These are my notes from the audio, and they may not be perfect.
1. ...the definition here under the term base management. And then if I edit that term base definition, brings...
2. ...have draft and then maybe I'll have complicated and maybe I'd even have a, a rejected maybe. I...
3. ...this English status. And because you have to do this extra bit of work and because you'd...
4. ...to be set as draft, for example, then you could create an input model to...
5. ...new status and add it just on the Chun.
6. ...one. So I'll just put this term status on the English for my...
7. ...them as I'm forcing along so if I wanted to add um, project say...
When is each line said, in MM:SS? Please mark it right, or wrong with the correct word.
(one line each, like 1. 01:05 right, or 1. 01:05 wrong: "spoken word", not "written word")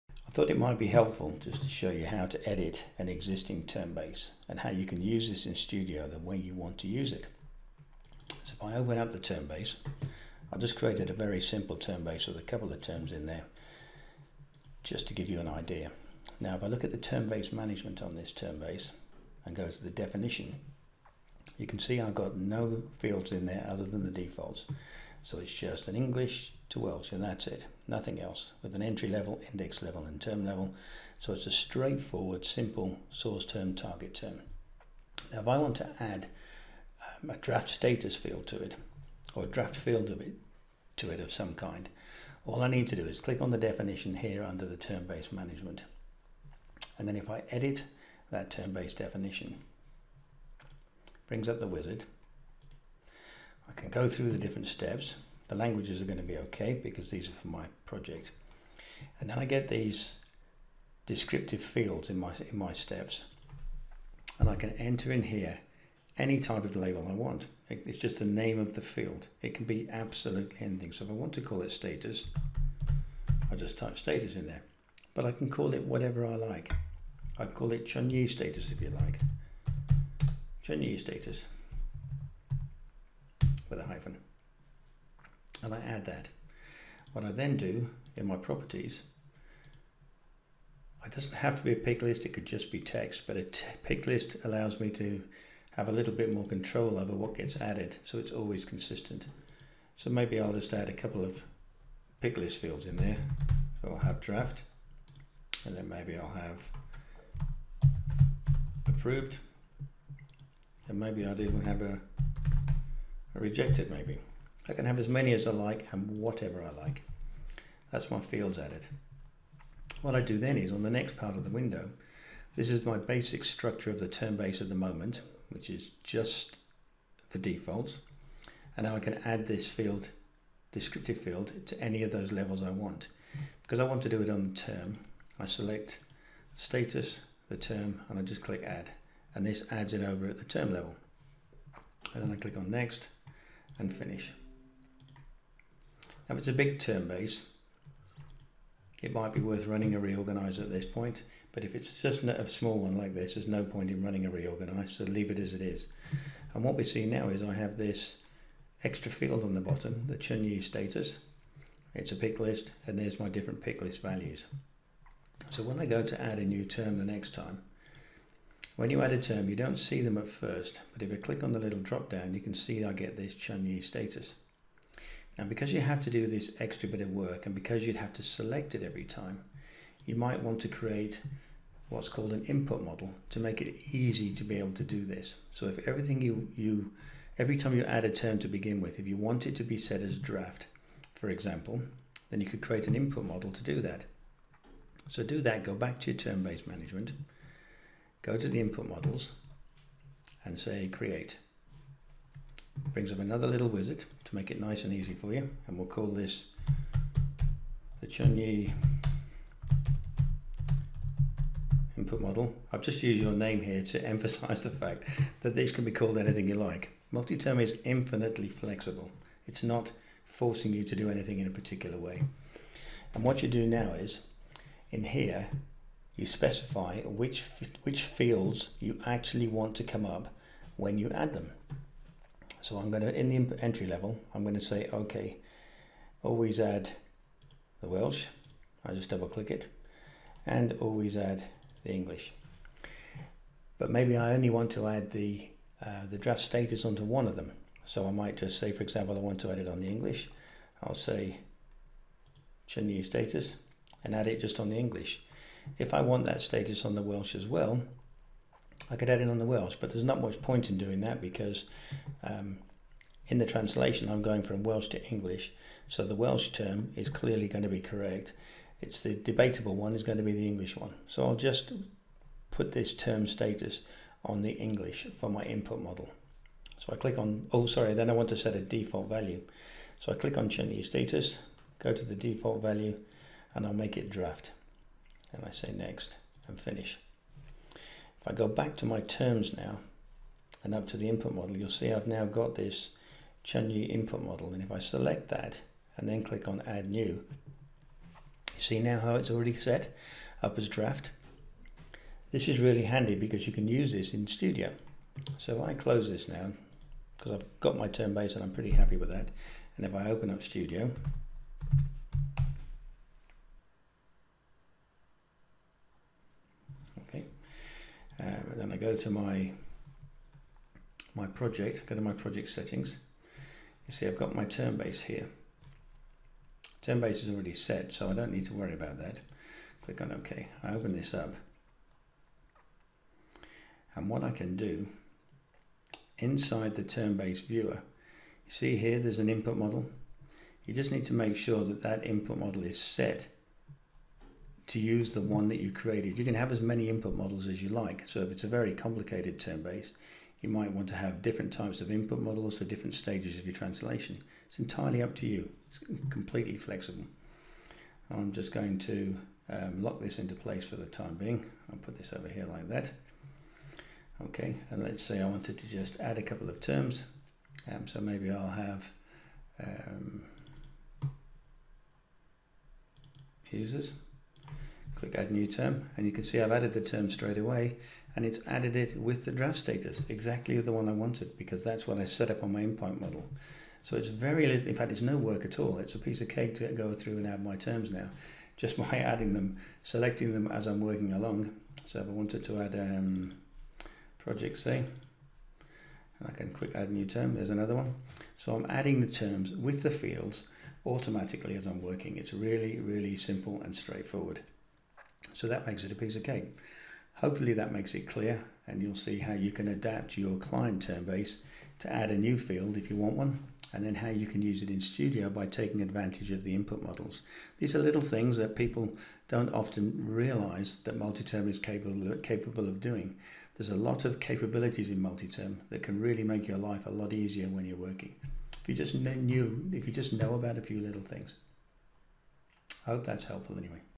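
1. 00:43 right
2. 01:43 wrong: "approved", not "complicated"
3. 02:53 wrong: "Chun", not "English"
4. 03:09 right
5. 04:12 wrong: "English", not "Chun"
6. 04:30 right
7. 06:30 wrong: "working", not "forcing".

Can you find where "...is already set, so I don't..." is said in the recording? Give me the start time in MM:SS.
05:27.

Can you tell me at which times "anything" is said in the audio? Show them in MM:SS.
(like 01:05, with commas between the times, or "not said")
01:10, 03:36, 03:41.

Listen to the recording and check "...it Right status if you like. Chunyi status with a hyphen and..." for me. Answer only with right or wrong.
wrong.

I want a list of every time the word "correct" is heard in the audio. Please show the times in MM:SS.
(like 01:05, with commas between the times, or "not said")
04:27.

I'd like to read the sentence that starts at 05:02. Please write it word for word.
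This is really handy because you can use this in Studio.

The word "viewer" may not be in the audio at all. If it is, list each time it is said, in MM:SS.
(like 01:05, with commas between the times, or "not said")
05:37.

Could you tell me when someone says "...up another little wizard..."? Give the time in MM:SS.
03:23.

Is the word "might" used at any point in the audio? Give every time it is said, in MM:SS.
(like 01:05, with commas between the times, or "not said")
00:00, 02:29, 03:00, 04:08, 05:50.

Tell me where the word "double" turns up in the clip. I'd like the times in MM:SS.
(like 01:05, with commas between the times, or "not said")
03:59.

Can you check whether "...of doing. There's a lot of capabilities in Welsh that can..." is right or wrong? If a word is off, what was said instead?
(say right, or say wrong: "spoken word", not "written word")
wrong: "MultiTerm", not "Welsh".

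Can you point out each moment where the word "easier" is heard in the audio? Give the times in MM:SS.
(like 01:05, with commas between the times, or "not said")
07:07.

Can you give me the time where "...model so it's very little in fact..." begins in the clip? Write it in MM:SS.
06:23.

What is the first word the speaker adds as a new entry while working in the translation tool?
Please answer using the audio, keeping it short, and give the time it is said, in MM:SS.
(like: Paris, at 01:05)
Users, at 06:13.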